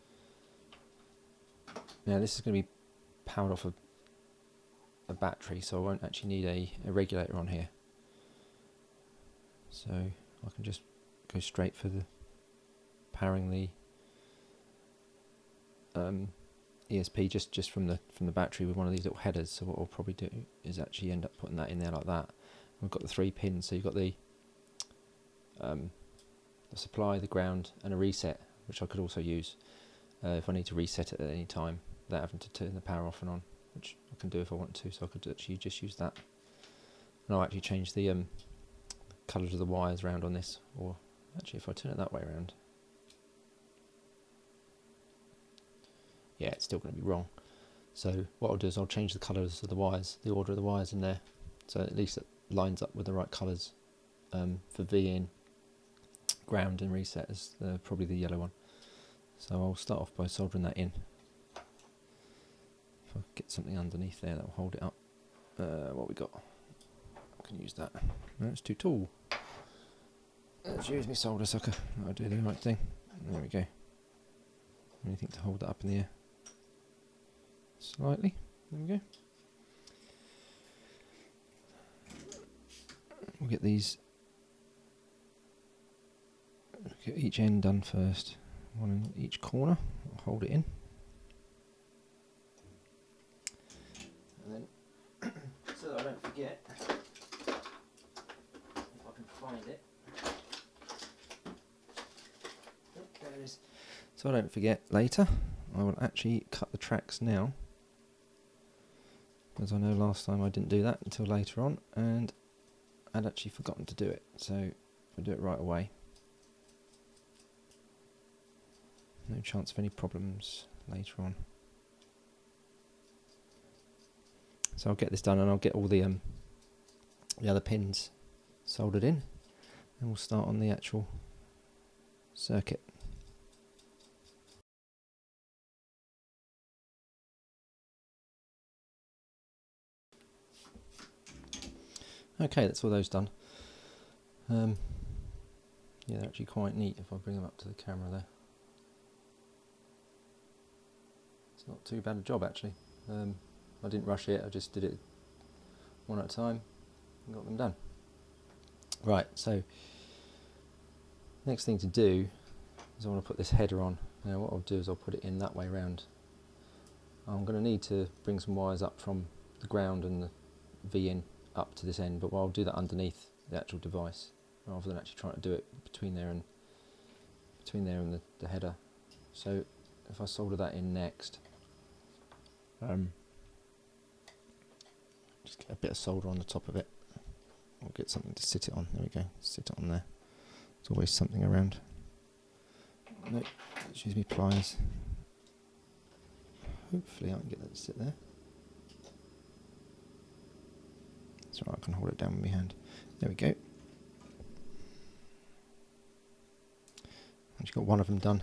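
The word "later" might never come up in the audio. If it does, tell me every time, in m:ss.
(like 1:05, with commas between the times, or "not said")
1:44, 1:51, 2:00.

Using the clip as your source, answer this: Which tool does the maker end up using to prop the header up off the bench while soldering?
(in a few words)
solder sucker.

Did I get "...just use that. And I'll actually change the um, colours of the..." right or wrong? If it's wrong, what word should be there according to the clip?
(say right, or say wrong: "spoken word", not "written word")
right.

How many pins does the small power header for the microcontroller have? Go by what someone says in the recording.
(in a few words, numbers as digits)
3.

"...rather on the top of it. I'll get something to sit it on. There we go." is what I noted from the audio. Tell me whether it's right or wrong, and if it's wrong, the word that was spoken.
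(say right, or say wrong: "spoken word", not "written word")
wrong: "solder", not "rather".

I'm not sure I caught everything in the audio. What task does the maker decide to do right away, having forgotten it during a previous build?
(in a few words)
cut the tracks.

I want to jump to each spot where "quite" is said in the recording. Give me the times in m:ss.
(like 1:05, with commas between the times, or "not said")
2:26.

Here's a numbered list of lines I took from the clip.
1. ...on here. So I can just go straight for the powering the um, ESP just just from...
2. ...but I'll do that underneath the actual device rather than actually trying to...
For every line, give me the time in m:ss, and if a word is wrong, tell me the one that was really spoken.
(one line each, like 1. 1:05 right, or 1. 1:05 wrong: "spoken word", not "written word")
1. 0:07 right
2. 2:52 right.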